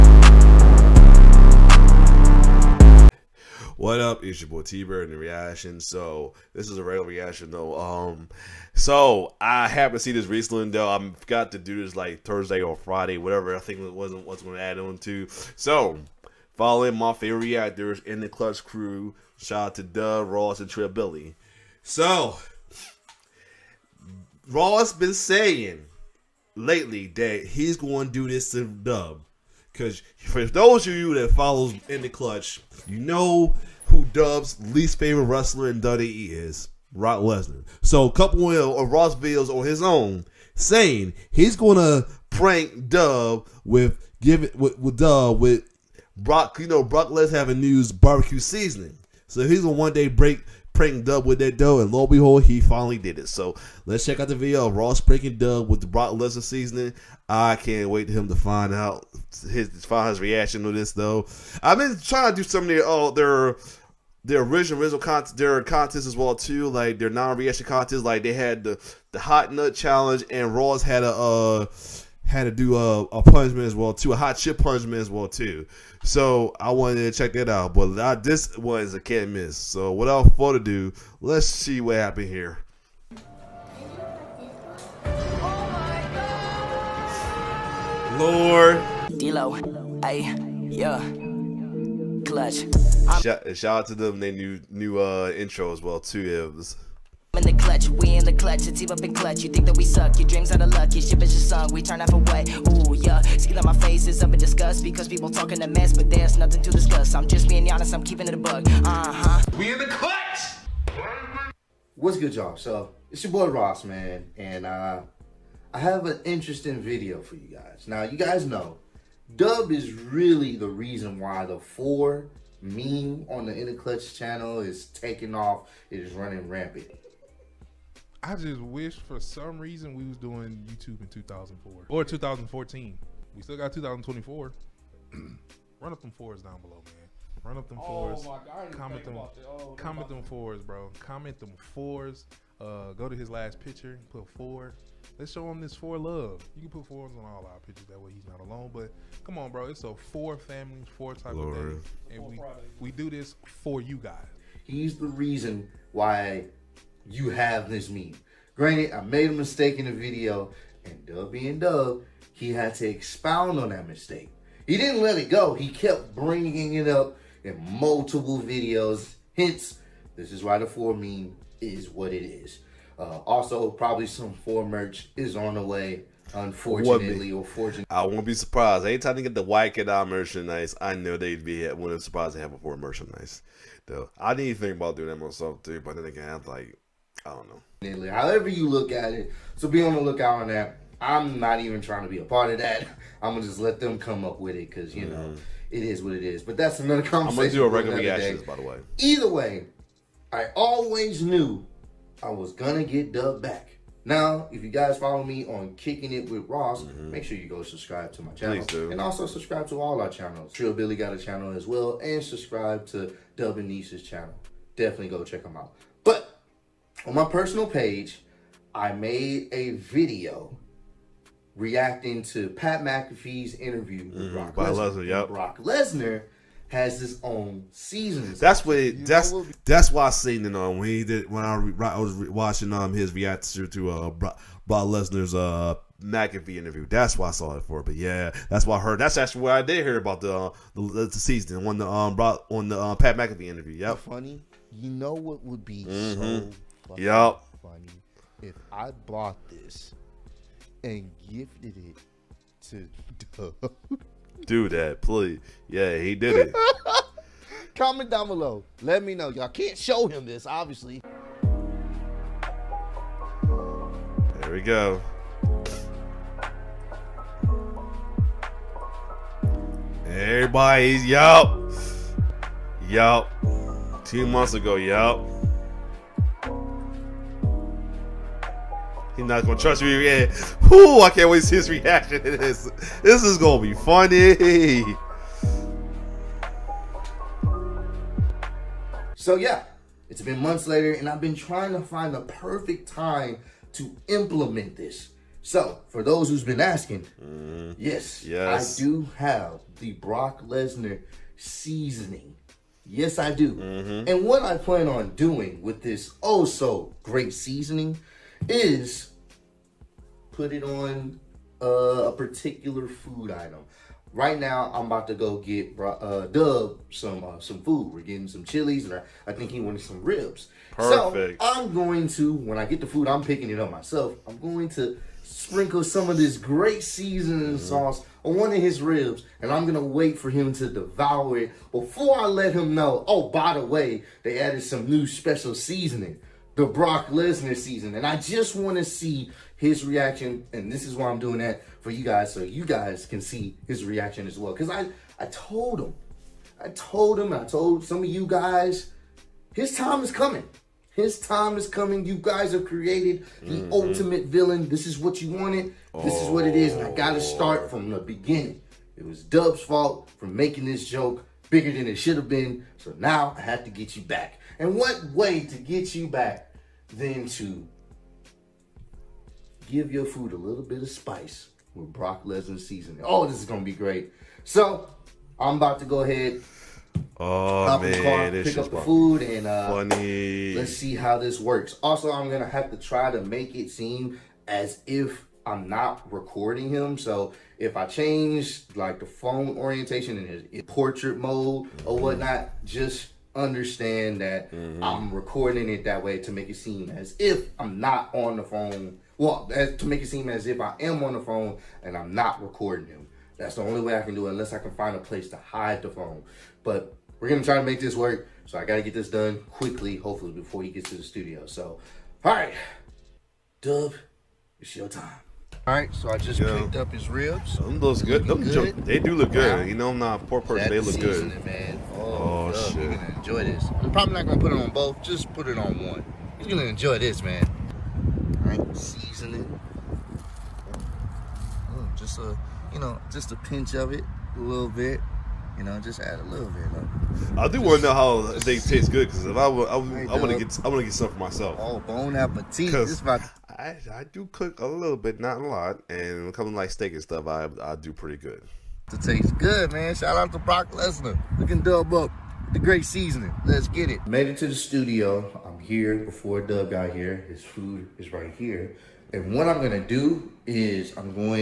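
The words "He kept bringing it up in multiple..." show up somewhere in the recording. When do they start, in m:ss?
2:45.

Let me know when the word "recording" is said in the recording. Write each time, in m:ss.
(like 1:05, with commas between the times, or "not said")
6:26, 6:35, 6:42.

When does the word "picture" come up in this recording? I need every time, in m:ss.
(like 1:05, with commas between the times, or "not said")
2:23, 2:27.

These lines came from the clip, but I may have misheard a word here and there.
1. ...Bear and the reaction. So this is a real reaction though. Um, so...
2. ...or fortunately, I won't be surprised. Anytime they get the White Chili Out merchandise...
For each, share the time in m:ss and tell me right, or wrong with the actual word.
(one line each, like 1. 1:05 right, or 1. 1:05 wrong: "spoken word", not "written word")
1. 0:04 right
2. 2:57 wrong: "Kid", not "Chili".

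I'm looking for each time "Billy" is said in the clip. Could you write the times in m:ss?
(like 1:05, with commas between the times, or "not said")
0:20, 3:30.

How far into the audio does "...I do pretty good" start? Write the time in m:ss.
7:27.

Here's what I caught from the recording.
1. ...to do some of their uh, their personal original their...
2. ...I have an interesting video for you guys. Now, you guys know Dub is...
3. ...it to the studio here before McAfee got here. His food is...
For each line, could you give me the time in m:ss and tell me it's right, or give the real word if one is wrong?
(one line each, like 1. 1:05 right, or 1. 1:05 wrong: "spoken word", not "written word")
1. 1:02 wrong: "original", not "personal"
2. 1:55 right
3. 7:34 wrong: "Dub", not "McAfee".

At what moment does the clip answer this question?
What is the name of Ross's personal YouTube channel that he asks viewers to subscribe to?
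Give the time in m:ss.
3:25.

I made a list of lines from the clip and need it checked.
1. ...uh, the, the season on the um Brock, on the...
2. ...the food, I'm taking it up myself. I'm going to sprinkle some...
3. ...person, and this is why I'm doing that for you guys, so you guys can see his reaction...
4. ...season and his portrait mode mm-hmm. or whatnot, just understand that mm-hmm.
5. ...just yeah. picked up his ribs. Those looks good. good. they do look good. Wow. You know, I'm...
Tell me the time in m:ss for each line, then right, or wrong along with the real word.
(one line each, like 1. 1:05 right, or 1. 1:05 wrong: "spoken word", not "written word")
1. 4:00 right
2. 5:22 wrong: "picking", not "taking"
3. 5:39 wrong: "reaction", not "person"
4. 6:29 wrong: "orientation", not "season"
5. 6:56 right.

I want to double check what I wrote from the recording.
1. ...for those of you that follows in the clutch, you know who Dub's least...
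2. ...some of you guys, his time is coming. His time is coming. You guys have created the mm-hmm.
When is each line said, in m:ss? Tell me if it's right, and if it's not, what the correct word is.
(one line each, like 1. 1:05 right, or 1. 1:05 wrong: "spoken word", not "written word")
1. 0:30 right
2. 5:47 right.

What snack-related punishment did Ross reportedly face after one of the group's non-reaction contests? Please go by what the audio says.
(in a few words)
hot chip punishment.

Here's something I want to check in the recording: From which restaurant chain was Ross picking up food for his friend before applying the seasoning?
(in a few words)
Chili's.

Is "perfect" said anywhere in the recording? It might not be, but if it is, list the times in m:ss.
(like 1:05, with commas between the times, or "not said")
4:52, 5:20.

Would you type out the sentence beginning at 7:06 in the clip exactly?
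He's gonna enjoy this, man right?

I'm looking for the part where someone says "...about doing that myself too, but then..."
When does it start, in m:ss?
3:04.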